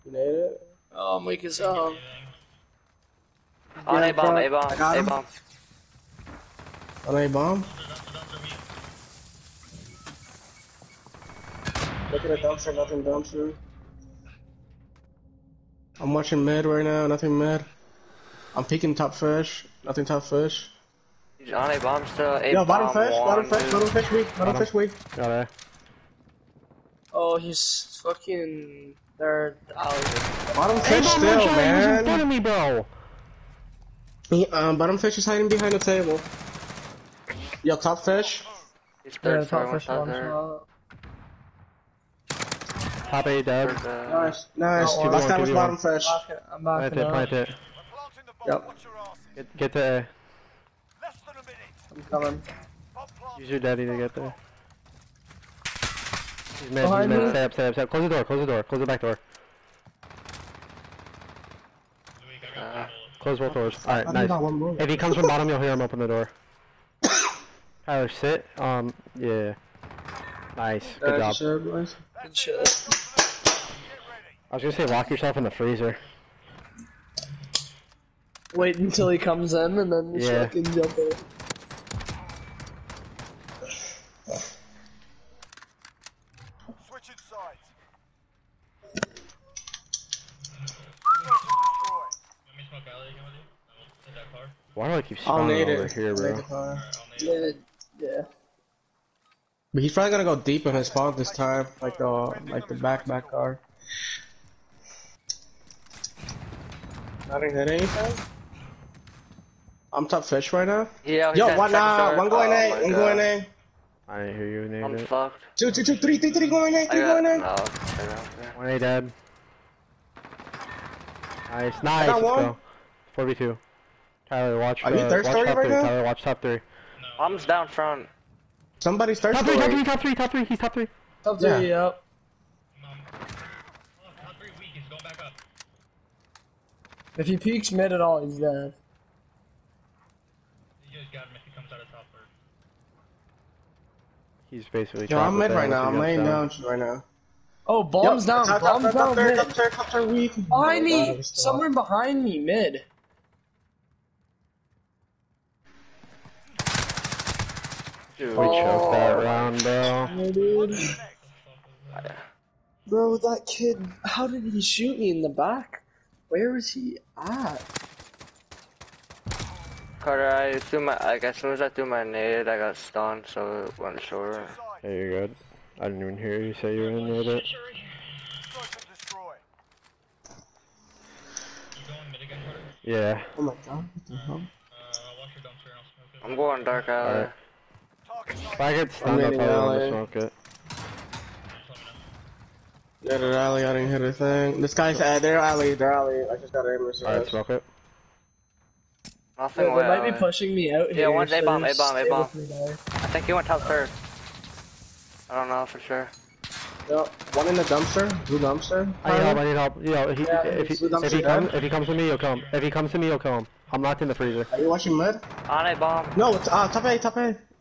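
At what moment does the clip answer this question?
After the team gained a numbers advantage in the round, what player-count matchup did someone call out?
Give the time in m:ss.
2:03.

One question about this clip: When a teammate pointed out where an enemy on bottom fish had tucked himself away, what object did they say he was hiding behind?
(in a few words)
The table.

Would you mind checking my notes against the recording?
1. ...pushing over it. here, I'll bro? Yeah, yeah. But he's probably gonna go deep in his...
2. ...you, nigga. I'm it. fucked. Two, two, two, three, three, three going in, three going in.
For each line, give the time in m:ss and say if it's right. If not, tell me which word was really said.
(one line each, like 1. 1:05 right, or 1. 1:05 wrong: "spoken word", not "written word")
1. 1:35 wrong: "spawning", not "pushing"
2. 1:54 right.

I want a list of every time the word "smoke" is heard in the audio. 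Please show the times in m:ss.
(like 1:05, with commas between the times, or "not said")
3:09, 3:17.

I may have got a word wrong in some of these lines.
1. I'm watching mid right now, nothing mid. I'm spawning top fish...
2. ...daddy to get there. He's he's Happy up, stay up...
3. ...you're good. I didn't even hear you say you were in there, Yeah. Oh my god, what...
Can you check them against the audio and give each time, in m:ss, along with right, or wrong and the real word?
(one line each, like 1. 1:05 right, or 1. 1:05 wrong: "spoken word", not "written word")
1. 0:15 wrong: "peeking", not "spawning"
2. 0:53 wrong: "Stay", not "Happy"
3. 2:54 right.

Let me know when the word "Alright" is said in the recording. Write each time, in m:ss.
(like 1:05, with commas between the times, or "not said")
1:03, 3:17.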